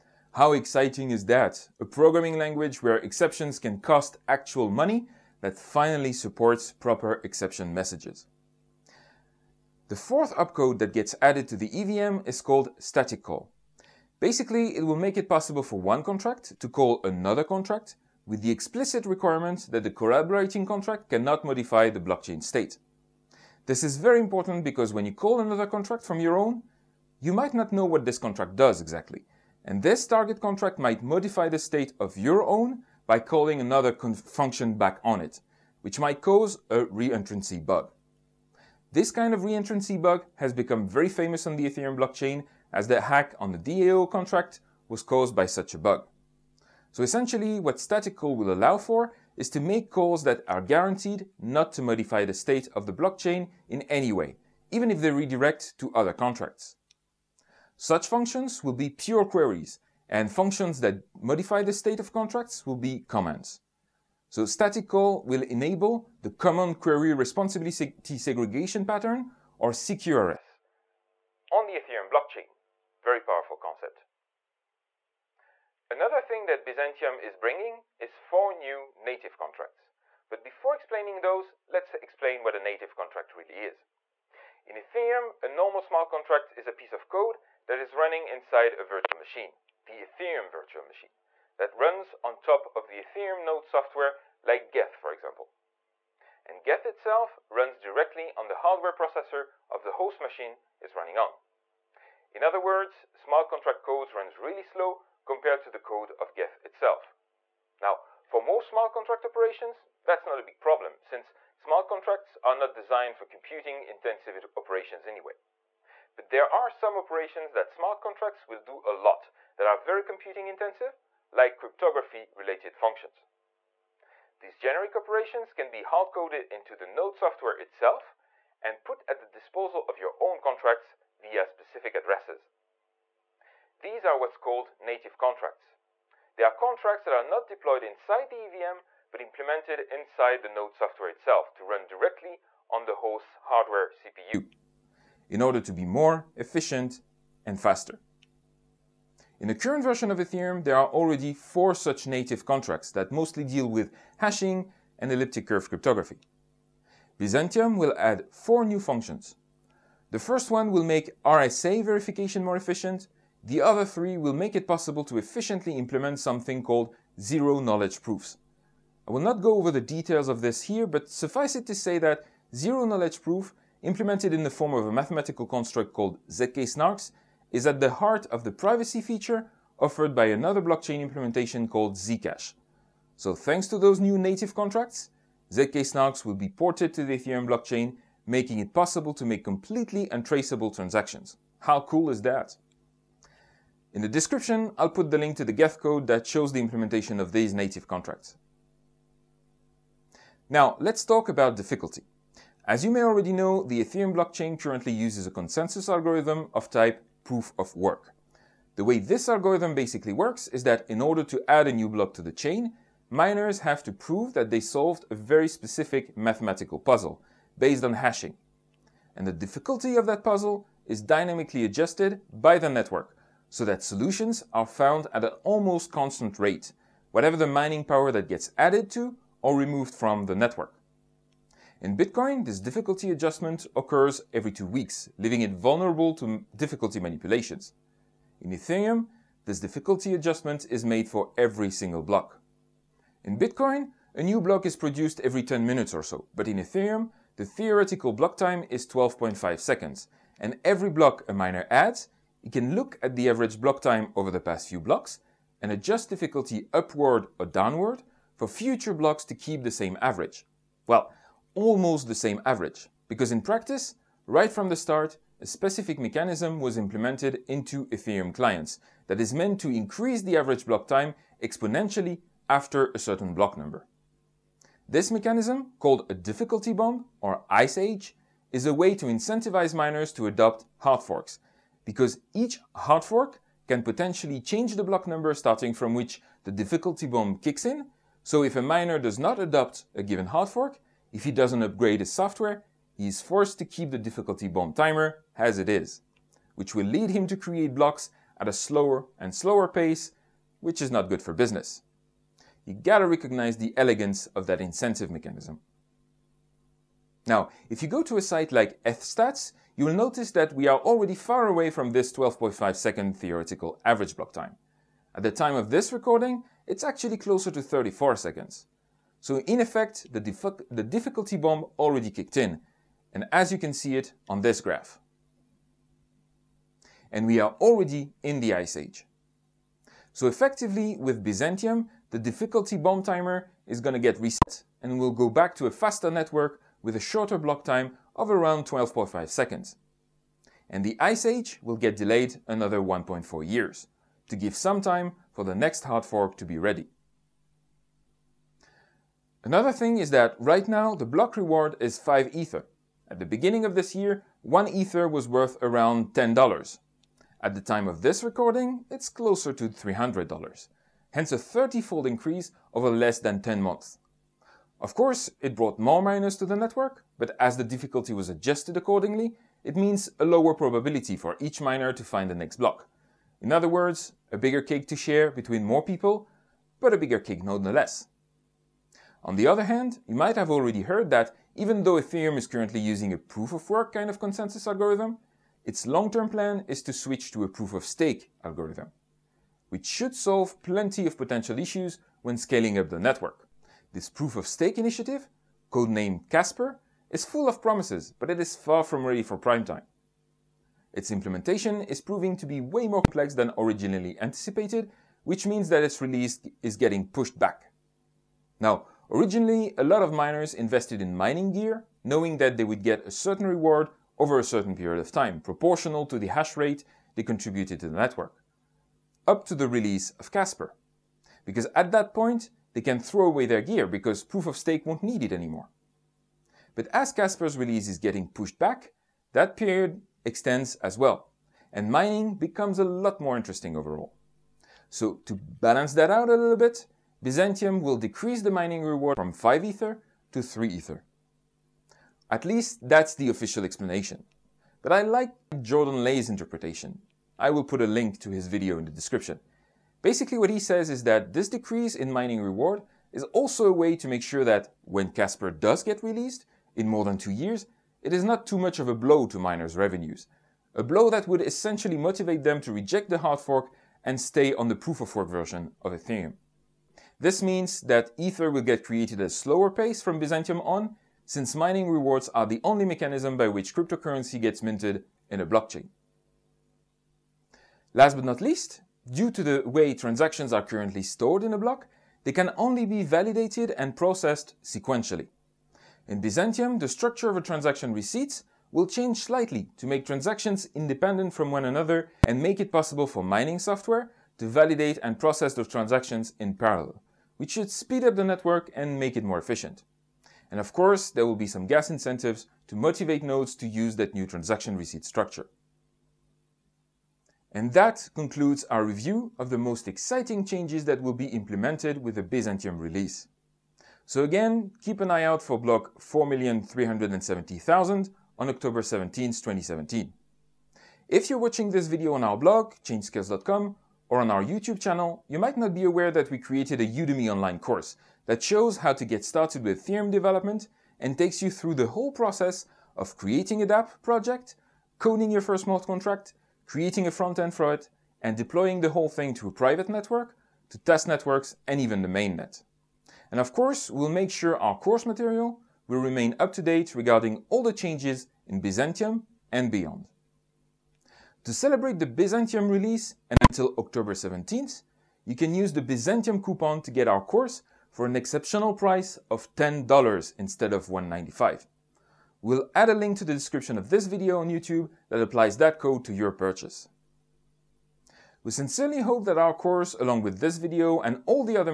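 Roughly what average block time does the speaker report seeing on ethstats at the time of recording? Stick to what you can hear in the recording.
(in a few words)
34 seconds.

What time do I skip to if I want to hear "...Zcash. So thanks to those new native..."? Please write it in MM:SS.
03:01.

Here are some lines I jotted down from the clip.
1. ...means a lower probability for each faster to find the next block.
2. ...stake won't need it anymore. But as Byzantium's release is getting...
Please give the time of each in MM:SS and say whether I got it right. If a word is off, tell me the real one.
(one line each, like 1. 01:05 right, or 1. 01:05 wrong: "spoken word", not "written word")
1. 06:09 wrong: "miner", not "faster"
2. 07:04 wrong: "Casper", not "Byzantium".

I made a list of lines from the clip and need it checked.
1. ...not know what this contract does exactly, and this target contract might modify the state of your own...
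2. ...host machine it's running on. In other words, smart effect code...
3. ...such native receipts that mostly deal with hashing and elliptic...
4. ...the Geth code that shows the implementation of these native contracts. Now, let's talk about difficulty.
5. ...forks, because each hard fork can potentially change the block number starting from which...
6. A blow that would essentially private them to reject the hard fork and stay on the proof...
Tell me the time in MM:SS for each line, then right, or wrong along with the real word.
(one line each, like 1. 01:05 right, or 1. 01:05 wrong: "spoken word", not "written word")
1. 00:27 right
2. 01:39 wrong: "contract", not "effect"
3. 02:31 wrong: "contracts", not "receipts"
4. 03:15 right
5. 04:41 right
6. 07:40 wrong: "motivate", not "private".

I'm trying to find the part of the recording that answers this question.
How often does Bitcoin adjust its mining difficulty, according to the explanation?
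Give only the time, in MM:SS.
03:54.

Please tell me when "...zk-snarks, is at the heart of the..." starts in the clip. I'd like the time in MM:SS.
02:56.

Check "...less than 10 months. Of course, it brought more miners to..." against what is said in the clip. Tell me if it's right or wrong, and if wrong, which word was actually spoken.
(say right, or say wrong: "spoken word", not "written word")
right.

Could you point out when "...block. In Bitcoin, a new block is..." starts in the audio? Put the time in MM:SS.
04:02.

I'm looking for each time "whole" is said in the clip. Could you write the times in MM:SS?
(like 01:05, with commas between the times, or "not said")
08:51, 08:58.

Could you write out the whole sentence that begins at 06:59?
Up to the release of Casper.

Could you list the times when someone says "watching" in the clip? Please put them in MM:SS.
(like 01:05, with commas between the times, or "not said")
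08:41.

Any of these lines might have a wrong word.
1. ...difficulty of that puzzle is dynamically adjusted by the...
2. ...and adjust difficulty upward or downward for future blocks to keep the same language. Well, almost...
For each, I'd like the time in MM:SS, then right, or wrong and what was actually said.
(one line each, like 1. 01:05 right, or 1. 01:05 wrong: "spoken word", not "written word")
1. 03:39 right
2. 04:15 wrong: "average", not "language".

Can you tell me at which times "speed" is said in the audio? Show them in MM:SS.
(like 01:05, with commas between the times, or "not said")
08:17.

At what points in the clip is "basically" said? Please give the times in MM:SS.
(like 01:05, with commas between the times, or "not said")
00:14, 03:29, 07:30.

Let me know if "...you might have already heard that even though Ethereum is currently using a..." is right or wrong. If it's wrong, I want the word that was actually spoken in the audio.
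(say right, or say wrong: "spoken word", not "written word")
right.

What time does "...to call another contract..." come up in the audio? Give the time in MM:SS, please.
00:16.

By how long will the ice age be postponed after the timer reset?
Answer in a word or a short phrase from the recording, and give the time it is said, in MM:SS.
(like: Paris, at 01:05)
1.4 years, at 05:42.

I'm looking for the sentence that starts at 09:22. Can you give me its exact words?
We'll add a link to the description of this video on YouTube that applies that code to your purchase.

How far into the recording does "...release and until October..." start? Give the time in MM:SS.
09:12.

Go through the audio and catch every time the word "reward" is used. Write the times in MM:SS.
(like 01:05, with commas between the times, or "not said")
05:51, 06:53, 07:18, 07:32, 07:51.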